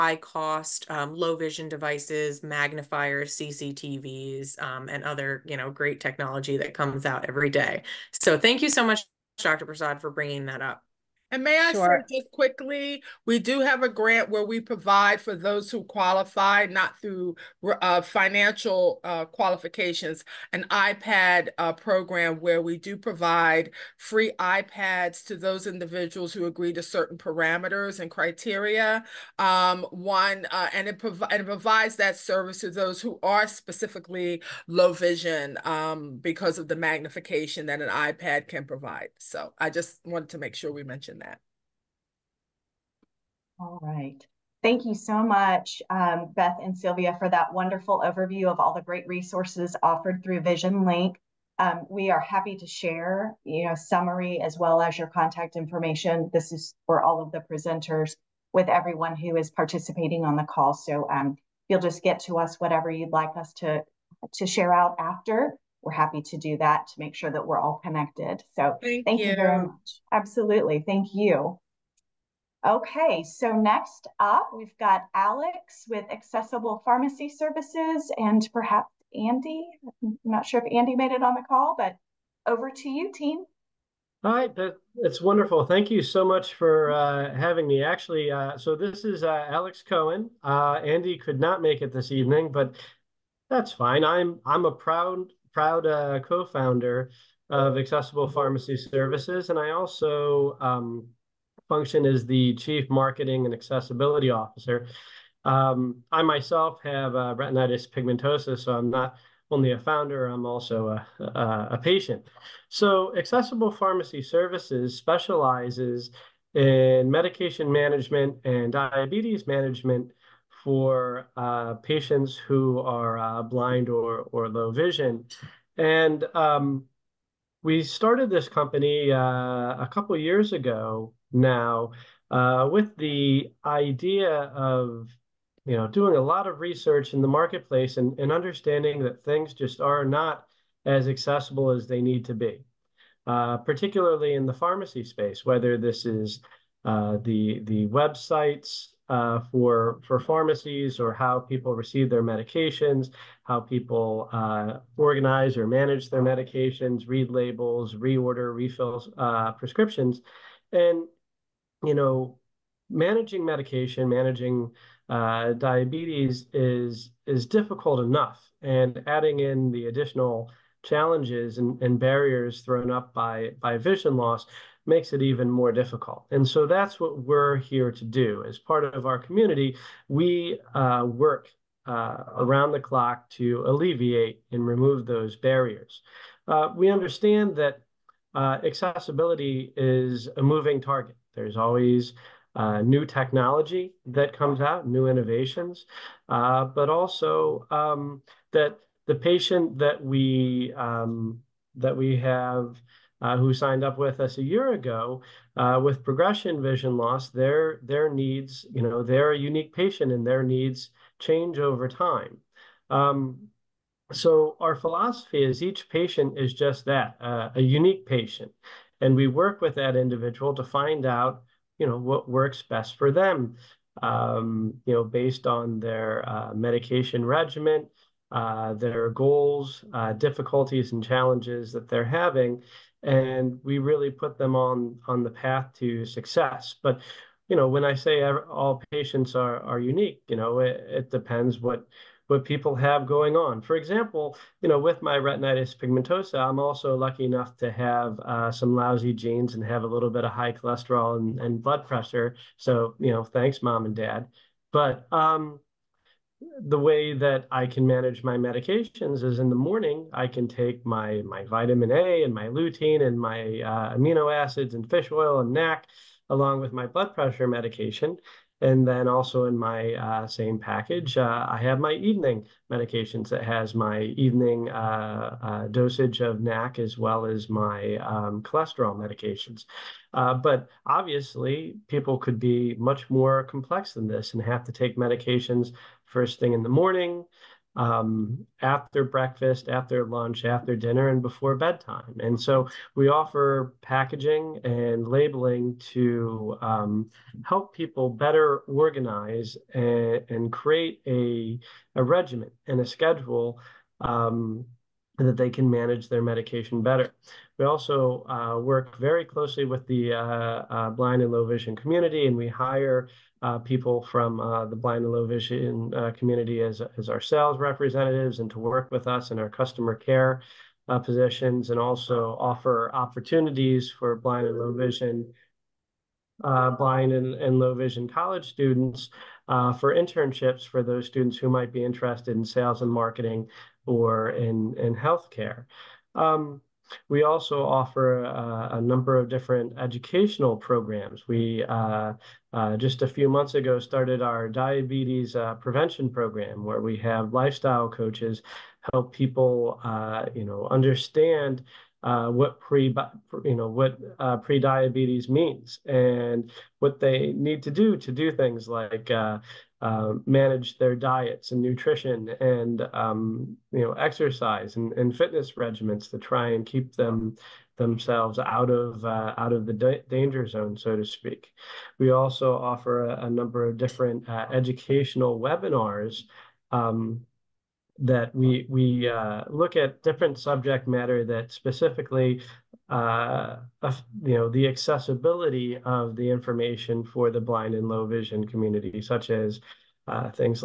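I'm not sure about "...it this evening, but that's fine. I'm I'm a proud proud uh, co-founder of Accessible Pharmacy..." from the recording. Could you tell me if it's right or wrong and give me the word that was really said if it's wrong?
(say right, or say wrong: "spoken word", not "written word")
right.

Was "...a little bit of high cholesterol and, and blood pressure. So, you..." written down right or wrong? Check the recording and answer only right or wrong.
right.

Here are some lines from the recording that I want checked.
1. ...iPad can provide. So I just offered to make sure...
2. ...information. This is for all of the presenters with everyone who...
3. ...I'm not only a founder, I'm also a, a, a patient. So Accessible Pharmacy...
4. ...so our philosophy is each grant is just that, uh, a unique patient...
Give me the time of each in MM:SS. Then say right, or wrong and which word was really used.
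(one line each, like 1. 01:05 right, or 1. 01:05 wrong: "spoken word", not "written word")
1. 00:37 wrong: "wanted", not "offered"
2. 00:55 right
3. 01:48 right
4. 03:34 wrong: "patient", not "grant".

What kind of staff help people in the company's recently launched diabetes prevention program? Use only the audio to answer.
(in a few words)
lifestyle coaches.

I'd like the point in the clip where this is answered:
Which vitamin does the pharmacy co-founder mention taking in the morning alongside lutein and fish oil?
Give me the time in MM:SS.
04:21.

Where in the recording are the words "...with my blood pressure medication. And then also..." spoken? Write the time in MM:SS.
04:26.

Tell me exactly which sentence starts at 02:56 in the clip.
And so that's what we're here to do.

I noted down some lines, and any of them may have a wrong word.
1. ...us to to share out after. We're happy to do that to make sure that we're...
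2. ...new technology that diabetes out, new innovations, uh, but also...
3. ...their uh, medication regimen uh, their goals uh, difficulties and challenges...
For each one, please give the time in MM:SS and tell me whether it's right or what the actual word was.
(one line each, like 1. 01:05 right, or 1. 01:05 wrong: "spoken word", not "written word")
1. 01:03 right
2. 03:12 wrong: "comes", not "diabetes"
3. 03:45 right.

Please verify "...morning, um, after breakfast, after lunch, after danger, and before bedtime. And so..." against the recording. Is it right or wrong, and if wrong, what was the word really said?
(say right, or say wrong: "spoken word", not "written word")
wrong: "dinner", not "danger".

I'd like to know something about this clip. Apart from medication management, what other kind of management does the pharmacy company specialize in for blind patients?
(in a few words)
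diabetes management.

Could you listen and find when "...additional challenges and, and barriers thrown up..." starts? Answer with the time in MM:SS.
02:49.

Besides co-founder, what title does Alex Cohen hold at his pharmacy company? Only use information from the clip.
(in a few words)
Chief Marketing and Accessibility Officer.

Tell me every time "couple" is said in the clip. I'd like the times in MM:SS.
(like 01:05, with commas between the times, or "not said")
02:09.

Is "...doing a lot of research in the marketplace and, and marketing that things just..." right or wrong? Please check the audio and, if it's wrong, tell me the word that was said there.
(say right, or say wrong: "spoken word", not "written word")
wrong: "understanding", not "marketing".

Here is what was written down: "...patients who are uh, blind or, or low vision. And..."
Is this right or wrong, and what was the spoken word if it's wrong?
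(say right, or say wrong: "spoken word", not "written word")
right.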